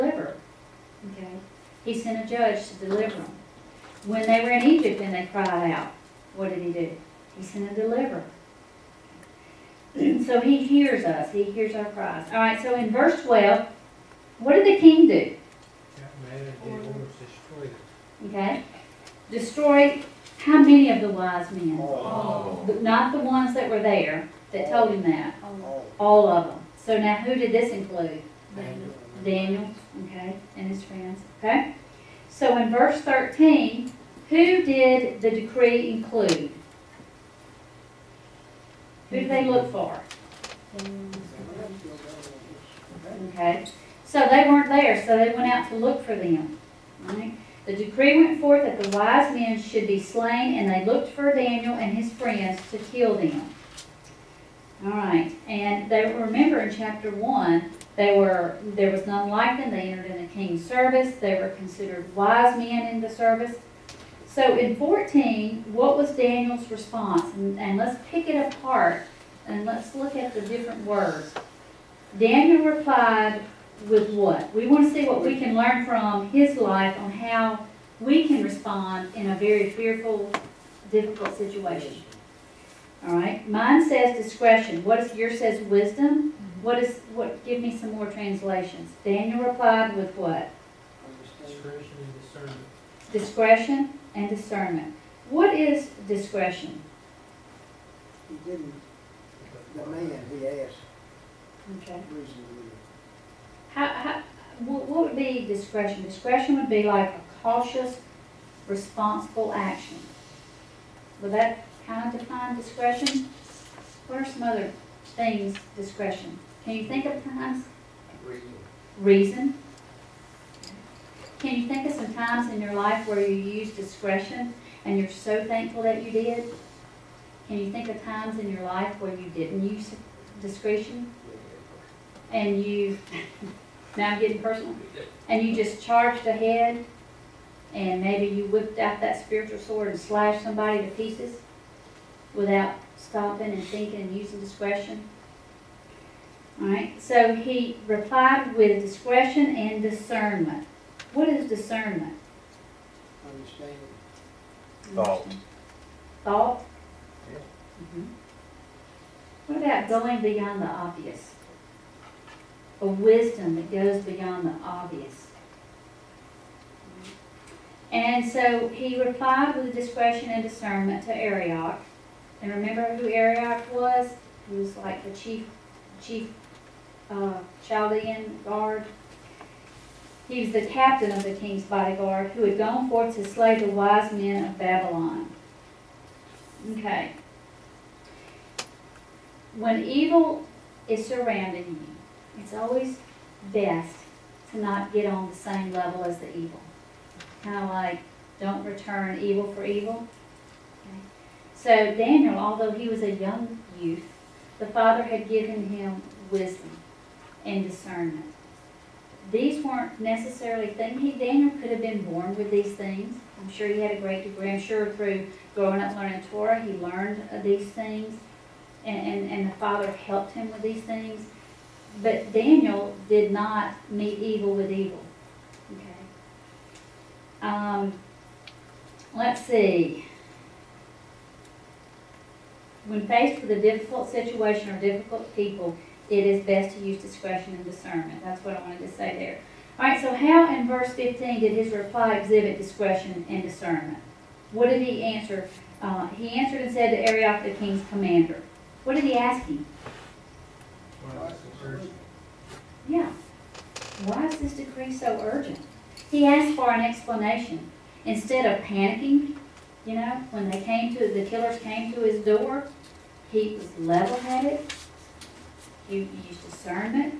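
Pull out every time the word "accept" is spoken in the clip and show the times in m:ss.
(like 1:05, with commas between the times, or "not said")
not said.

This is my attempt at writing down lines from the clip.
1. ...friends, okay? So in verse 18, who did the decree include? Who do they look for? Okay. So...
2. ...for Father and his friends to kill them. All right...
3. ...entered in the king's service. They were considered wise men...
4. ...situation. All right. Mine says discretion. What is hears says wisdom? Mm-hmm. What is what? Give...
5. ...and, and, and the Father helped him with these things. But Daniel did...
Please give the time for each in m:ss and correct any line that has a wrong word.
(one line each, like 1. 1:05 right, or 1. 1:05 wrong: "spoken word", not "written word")
1. 0:30 wrong: "13", not "18"
2. 0:51 wrong: "Daniel", not "Father"
3. 0:59 right
4. 1:21 wrong: "yours", not "hears"
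5. 3:38 right.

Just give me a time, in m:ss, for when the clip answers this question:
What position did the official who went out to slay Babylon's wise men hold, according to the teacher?
3:00.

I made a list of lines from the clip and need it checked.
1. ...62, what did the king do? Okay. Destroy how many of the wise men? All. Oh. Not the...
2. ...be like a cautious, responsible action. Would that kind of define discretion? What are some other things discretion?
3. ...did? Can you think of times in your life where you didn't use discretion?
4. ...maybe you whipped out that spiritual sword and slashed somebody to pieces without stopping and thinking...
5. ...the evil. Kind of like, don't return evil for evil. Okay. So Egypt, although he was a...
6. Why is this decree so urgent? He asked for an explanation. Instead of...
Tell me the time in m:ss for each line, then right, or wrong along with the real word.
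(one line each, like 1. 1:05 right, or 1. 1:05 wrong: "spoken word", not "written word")
1. 0:13 wrong: "12", not "62"
2. 1:46 right
3. 2:06 right
4. 2:18 right
5. 3:16 wrong: "Daniel", not "Egypt"
6. 4:14 right.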